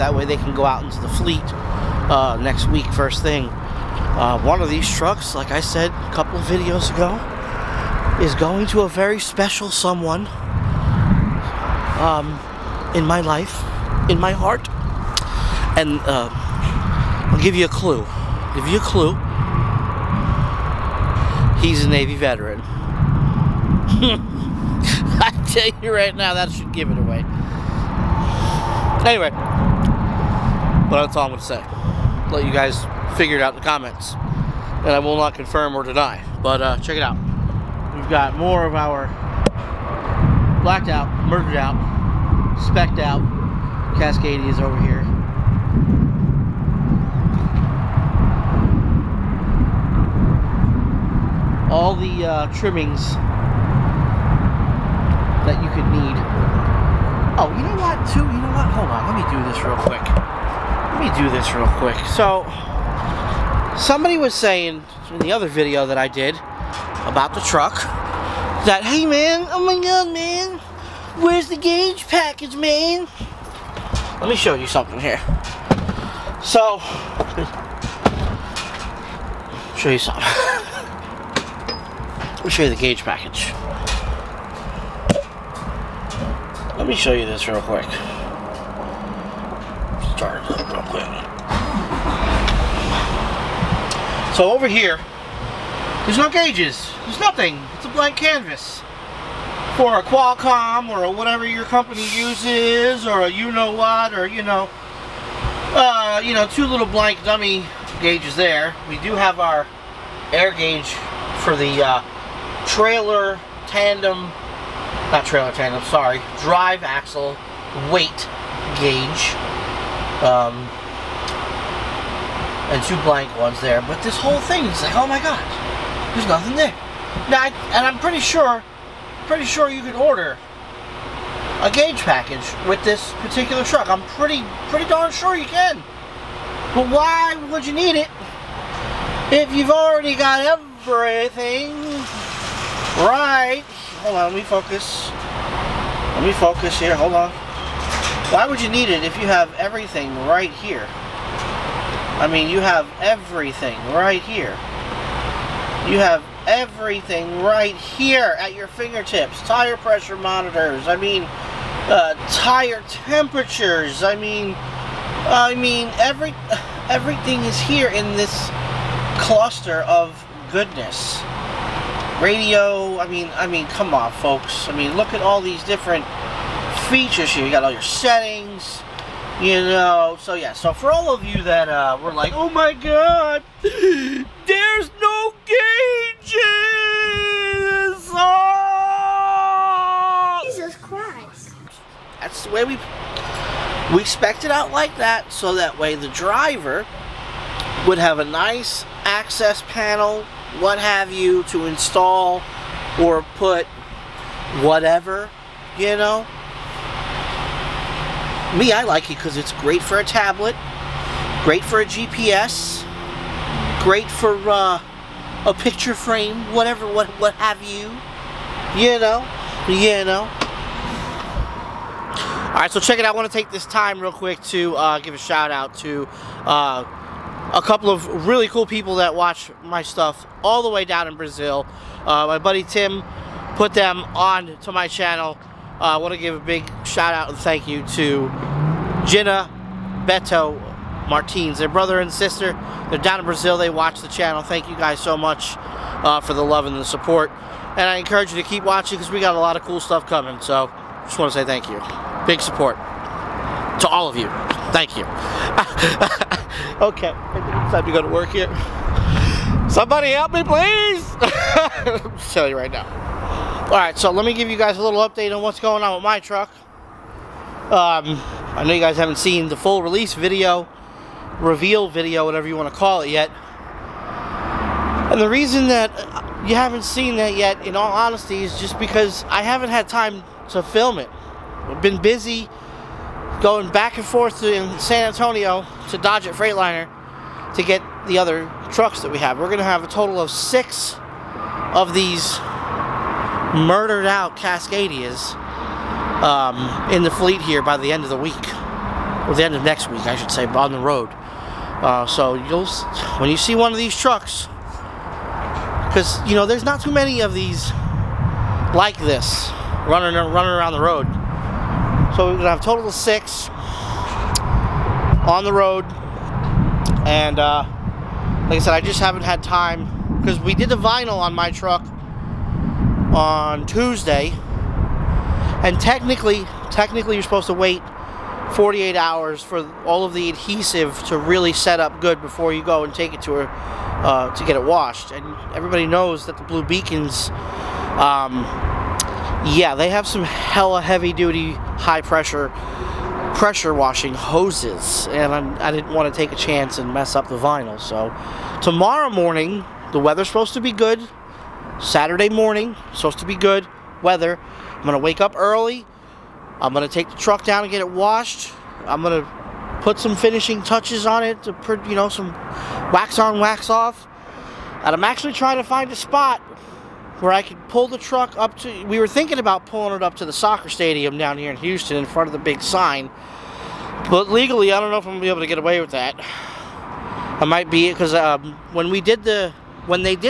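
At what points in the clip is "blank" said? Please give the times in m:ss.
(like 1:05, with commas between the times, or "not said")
1:37, 1:46, 2:03.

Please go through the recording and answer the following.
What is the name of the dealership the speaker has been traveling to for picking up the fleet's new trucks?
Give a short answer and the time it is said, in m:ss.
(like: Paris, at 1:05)
Doggett Freightliner, at 4:45.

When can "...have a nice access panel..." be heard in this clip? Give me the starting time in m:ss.
3:17.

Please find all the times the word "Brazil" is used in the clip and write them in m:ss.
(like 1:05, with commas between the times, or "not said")
3:51, 4:03.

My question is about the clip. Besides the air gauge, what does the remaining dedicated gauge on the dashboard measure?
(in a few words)
Drive axle weight.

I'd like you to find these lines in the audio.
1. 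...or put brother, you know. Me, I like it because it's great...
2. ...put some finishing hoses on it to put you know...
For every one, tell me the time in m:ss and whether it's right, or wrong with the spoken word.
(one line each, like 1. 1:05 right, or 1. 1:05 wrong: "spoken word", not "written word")
1. 3:23 wrong: "whatever", not "brother"
2. 5:59 wrong: "touches", not "hoses".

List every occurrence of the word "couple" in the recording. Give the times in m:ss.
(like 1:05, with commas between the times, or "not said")
0:06, 3:47.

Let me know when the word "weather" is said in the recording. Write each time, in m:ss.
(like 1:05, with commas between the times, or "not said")
5:49, 5:54.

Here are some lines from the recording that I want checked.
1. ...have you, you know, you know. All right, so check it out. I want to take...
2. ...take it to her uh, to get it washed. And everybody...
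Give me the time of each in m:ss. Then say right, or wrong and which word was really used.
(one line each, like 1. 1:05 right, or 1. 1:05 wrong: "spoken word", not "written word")
1. 3:37 right
2. 5:32 right.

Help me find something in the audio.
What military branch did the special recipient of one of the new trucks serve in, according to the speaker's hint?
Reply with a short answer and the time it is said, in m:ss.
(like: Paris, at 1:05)
Navy, at 0:21.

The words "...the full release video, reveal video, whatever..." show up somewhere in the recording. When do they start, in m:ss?
4:29.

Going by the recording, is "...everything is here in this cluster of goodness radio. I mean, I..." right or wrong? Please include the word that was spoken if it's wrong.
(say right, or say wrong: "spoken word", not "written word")
right.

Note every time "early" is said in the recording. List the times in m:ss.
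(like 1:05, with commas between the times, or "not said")
5:55.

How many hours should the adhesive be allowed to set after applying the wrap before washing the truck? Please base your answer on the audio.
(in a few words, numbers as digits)
48.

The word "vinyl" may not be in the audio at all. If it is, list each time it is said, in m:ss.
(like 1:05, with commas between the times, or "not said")
5:20, 5:47.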